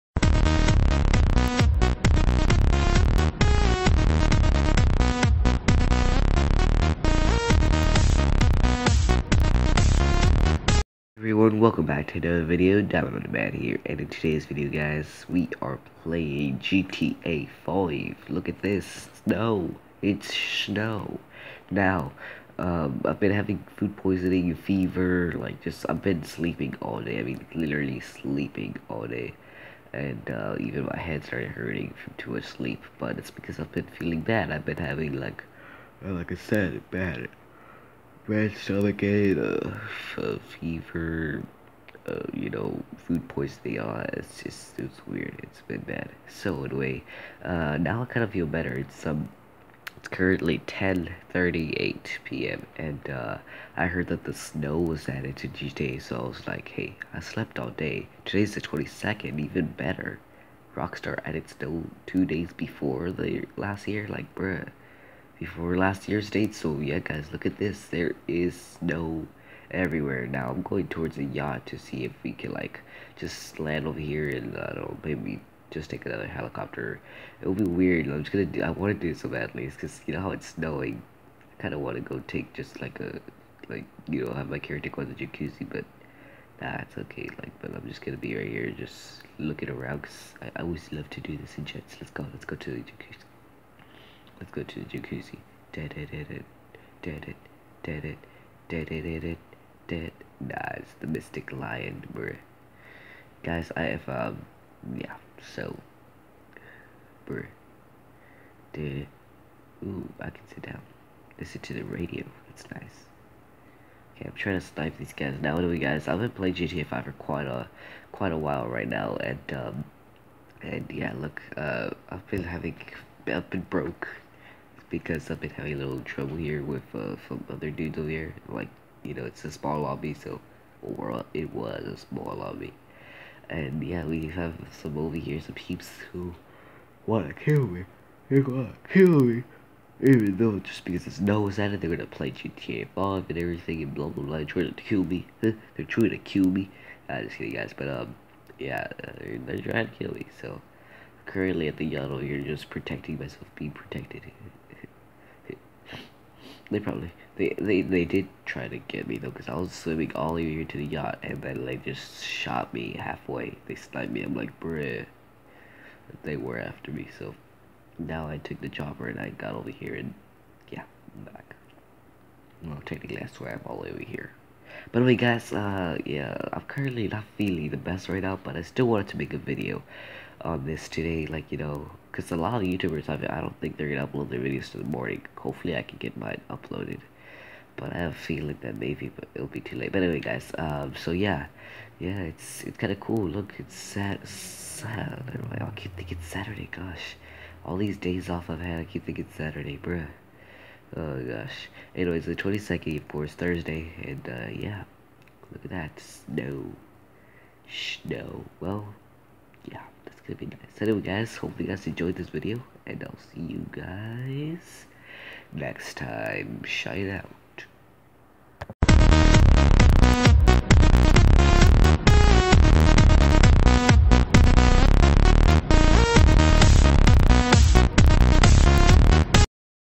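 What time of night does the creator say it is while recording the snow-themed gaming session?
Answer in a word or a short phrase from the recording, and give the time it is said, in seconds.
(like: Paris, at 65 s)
10:38 p.m., at 50 s.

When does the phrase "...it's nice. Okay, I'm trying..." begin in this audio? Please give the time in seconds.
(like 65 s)
112 s.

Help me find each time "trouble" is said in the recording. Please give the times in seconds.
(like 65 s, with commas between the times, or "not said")
126 s.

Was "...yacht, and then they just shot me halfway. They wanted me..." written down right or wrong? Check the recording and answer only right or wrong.
wrong.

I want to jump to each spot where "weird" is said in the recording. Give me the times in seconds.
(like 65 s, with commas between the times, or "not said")
45 s, 77 s.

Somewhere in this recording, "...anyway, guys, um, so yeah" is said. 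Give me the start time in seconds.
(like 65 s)
190 s.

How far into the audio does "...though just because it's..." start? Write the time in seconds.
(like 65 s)
140 s.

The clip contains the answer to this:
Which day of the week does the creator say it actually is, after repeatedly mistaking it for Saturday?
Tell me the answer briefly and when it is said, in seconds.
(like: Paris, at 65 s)
Thursday, at 203 s.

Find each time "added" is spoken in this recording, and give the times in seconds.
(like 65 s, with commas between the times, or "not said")
55 s, 61 s.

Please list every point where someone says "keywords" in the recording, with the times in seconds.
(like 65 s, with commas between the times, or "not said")
not said.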